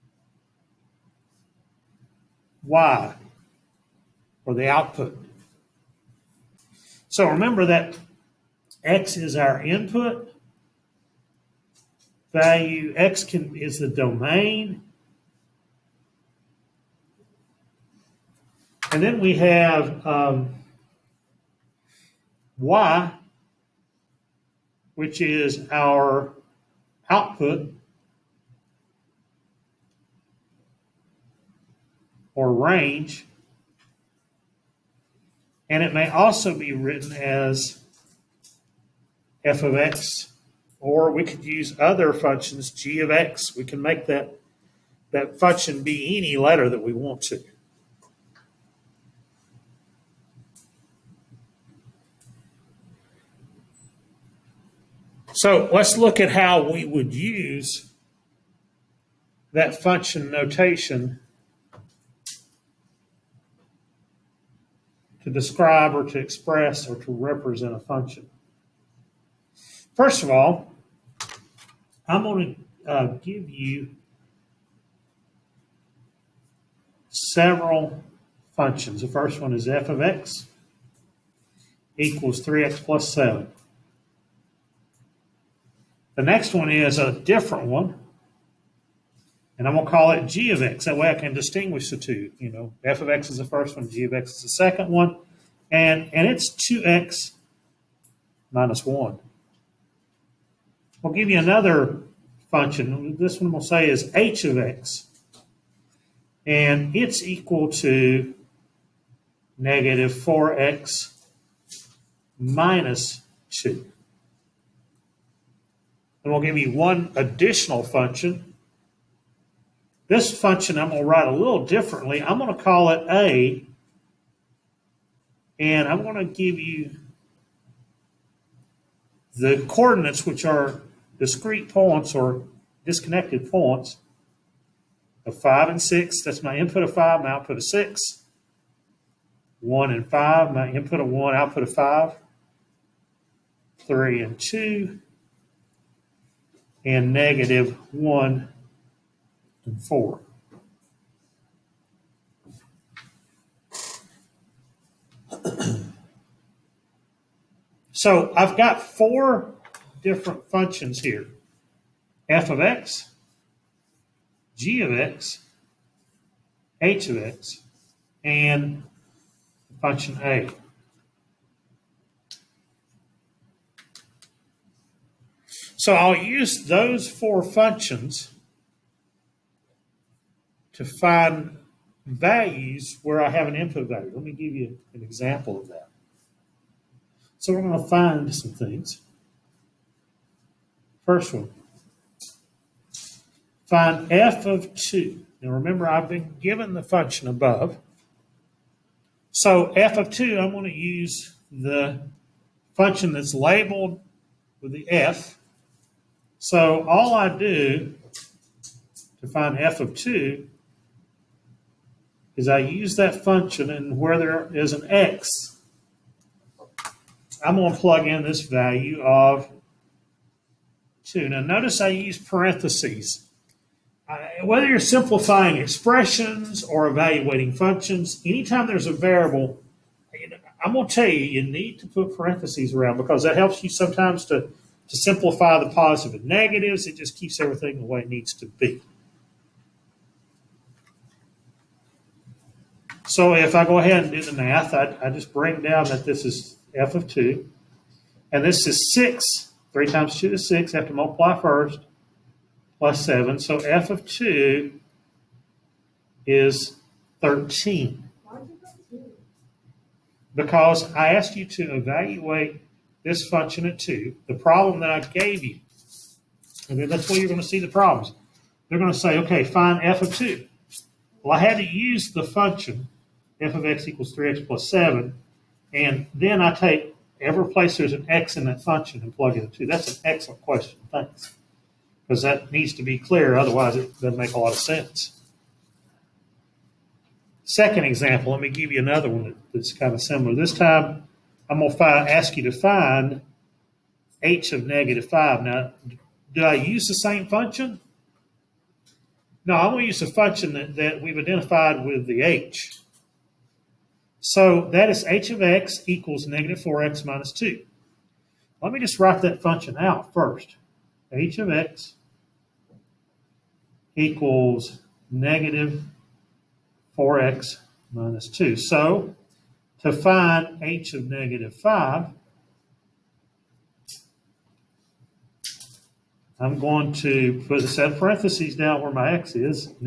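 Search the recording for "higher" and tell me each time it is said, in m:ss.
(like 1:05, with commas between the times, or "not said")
not said.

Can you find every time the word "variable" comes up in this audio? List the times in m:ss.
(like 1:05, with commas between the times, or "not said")
3:48.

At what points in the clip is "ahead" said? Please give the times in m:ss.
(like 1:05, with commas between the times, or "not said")
4:03.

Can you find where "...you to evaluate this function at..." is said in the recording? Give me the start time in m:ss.
4:21.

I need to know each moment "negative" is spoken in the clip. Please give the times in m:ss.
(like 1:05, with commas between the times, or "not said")
1:49, 2:27, 3:56, 4:54, 5:06, 5:15, 5:21.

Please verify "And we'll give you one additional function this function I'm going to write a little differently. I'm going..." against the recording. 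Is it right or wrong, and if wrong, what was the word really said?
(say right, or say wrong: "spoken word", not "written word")
right.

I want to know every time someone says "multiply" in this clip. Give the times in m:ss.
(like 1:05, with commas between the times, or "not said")
4:10.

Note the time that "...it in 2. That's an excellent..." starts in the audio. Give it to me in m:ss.
4:39.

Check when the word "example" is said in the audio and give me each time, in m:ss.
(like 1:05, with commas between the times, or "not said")
3:05, 4:47.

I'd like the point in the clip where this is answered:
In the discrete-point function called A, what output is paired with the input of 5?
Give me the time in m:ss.
2:17.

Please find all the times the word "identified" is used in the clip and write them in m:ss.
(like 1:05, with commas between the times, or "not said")
5:01.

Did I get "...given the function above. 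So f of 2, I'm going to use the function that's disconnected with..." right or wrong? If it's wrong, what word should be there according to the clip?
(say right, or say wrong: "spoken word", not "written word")
wrong: "labeled", not "disconnected".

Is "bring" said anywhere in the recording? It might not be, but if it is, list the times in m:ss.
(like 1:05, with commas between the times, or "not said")
4:05.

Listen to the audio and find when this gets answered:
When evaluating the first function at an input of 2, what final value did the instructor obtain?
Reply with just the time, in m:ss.
4:13.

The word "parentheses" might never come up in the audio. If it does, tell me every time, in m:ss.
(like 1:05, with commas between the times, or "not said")
3:42, 3:52, 5:27.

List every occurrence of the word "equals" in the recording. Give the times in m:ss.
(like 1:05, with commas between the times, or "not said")
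1:21, 1:47, 4:33, 5:05, 5:13.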